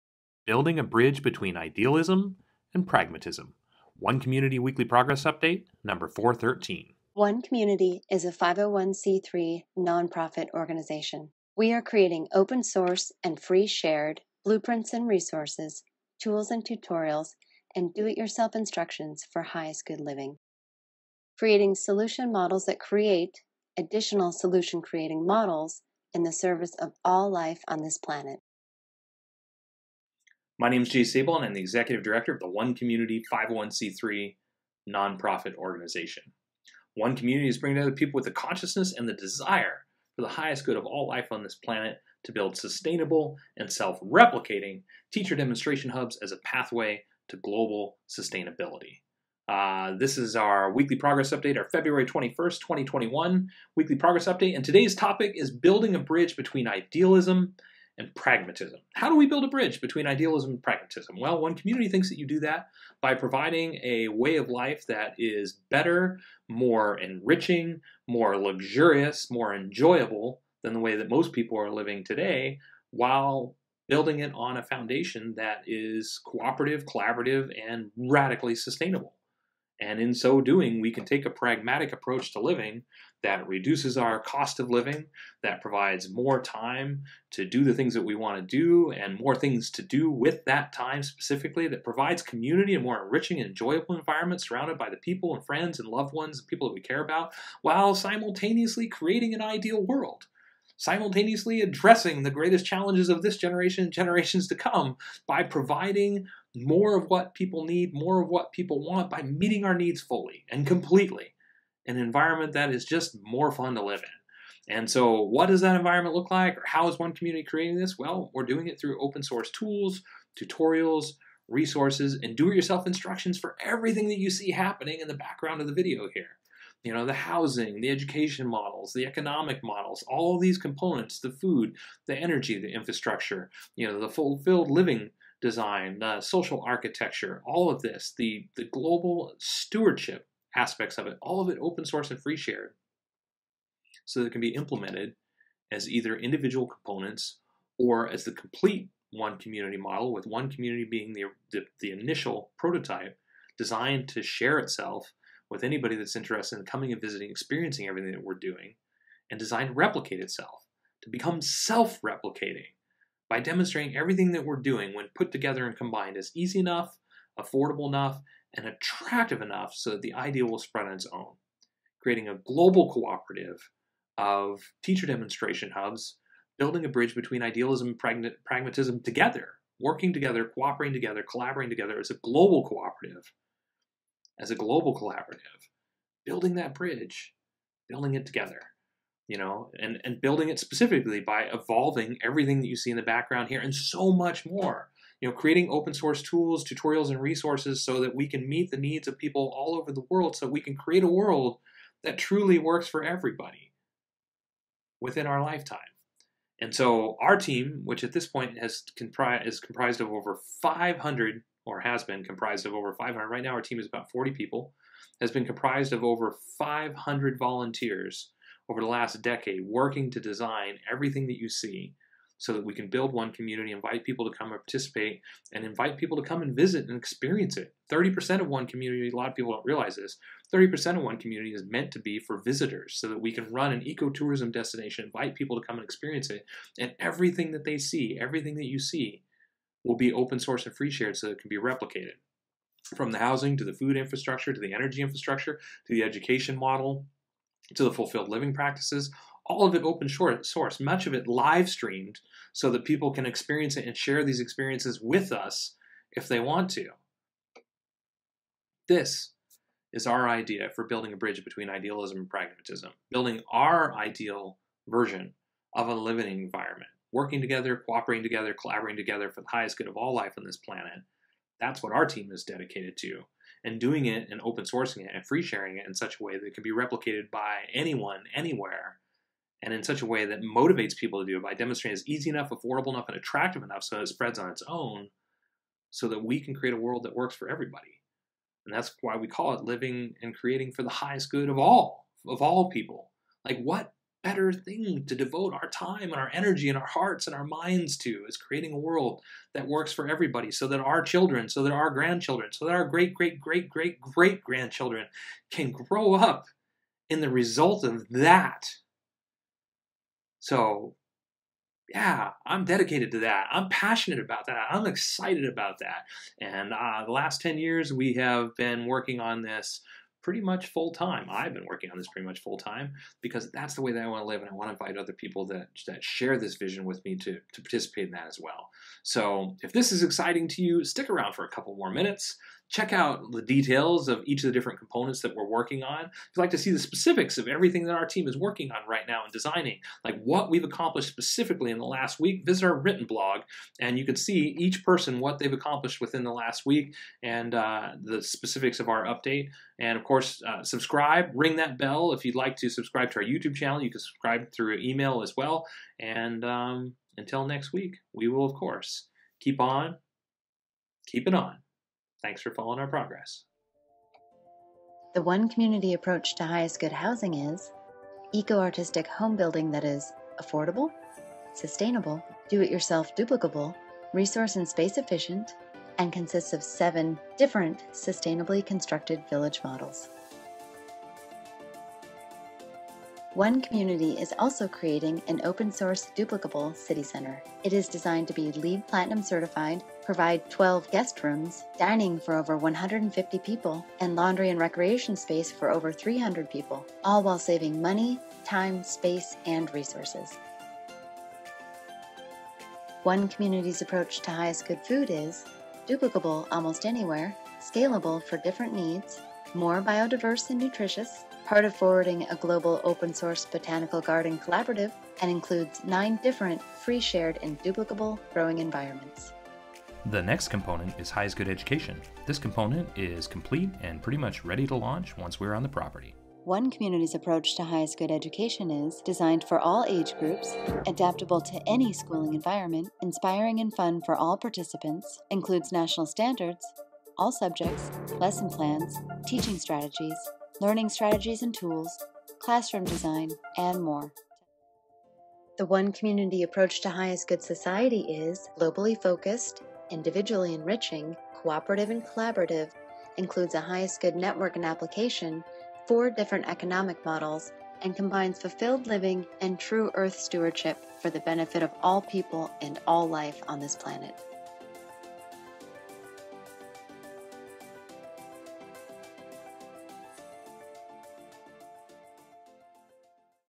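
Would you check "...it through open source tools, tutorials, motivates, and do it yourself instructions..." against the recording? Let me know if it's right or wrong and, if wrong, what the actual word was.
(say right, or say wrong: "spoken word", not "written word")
wrong: "resources", not "motivates".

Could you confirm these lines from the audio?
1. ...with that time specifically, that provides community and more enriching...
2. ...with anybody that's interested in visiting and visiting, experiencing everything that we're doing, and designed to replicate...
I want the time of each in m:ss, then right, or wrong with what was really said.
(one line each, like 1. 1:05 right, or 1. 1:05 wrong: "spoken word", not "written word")
1. 1:30 right
2. 2:35 wrong: "coming", not "visiting".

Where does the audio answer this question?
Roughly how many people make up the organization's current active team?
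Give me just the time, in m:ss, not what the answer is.
3:33.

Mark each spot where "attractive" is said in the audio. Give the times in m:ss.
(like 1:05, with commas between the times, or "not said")
2:48, 4:43.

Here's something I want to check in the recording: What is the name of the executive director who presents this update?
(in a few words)
Jay Sable.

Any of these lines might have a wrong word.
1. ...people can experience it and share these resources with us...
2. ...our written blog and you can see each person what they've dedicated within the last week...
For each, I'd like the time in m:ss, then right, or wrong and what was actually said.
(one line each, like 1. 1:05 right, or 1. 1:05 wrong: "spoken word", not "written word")
1. 4:12 wrong: "experiences", not "resources"
2. 5:42 wrong: "accomplished", not "dedicated".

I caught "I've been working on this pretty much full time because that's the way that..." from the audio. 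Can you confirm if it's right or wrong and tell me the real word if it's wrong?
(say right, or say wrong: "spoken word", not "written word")
right.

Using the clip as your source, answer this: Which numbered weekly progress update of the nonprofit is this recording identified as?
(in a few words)
413.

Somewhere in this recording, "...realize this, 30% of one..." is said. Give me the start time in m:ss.
3:49.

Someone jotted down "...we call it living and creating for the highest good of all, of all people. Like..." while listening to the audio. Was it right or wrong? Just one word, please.
right.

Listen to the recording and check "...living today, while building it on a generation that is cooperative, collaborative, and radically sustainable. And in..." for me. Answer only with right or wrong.
wrong.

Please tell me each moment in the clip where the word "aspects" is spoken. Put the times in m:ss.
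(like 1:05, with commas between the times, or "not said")
2:20.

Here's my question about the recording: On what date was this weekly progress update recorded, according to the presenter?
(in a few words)
February 21st, 2021.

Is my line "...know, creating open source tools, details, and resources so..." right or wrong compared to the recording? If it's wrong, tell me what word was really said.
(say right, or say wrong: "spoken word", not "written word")
wrong: "tutorials", not "details".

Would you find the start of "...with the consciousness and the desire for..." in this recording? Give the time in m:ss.
0:38.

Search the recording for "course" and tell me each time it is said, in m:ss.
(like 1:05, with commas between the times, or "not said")
5:50, 5:58.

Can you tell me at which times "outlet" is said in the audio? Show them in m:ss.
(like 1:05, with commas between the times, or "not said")
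not said.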